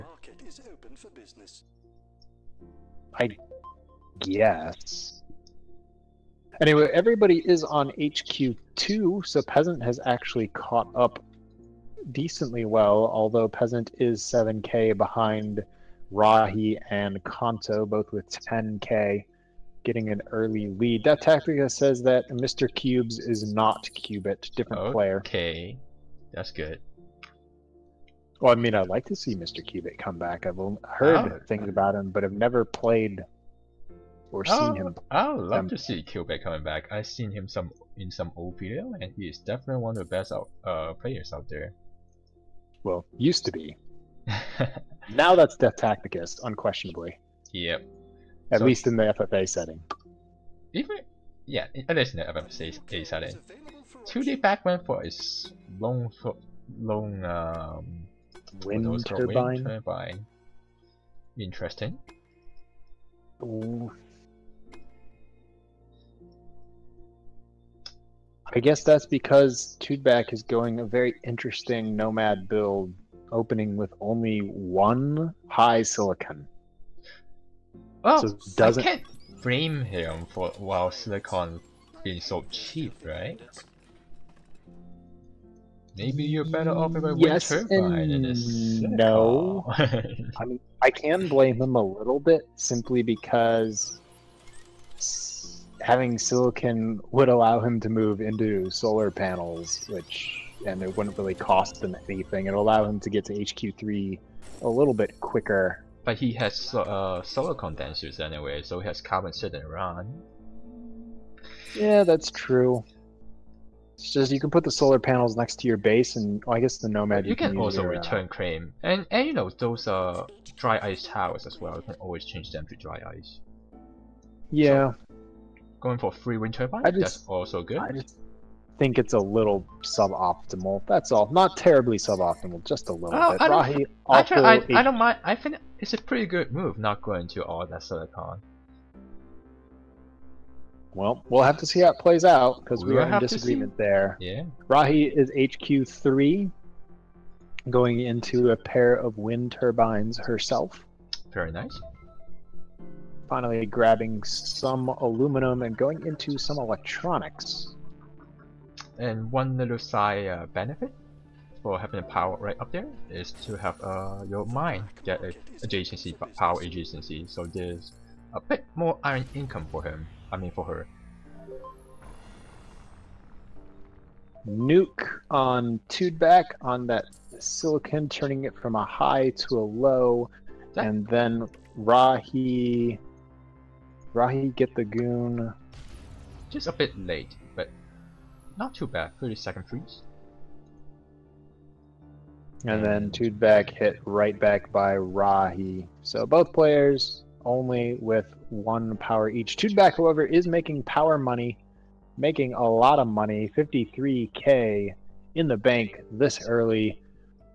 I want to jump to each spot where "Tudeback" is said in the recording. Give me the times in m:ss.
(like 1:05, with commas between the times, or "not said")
1:09, 2:55.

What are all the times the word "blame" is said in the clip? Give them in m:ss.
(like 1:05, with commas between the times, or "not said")
1:19, 1:31.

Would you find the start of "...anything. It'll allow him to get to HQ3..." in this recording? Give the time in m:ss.
1:42.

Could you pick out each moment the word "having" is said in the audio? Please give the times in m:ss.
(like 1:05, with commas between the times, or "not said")
1:35, 2:41.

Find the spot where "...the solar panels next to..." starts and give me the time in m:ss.
1:54.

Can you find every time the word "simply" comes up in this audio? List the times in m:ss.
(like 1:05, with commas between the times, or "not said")
1:32.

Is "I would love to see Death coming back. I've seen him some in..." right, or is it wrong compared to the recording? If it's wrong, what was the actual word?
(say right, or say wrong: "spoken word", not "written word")
wrong: "Cubit", not "Death".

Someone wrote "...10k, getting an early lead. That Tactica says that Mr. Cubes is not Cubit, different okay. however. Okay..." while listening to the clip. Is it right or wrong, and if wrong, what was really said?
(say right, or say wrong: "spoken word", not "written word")
wrong: "player", not "however".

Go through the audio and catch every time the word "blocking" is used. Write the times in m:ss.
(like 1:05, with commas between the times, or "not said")
not said.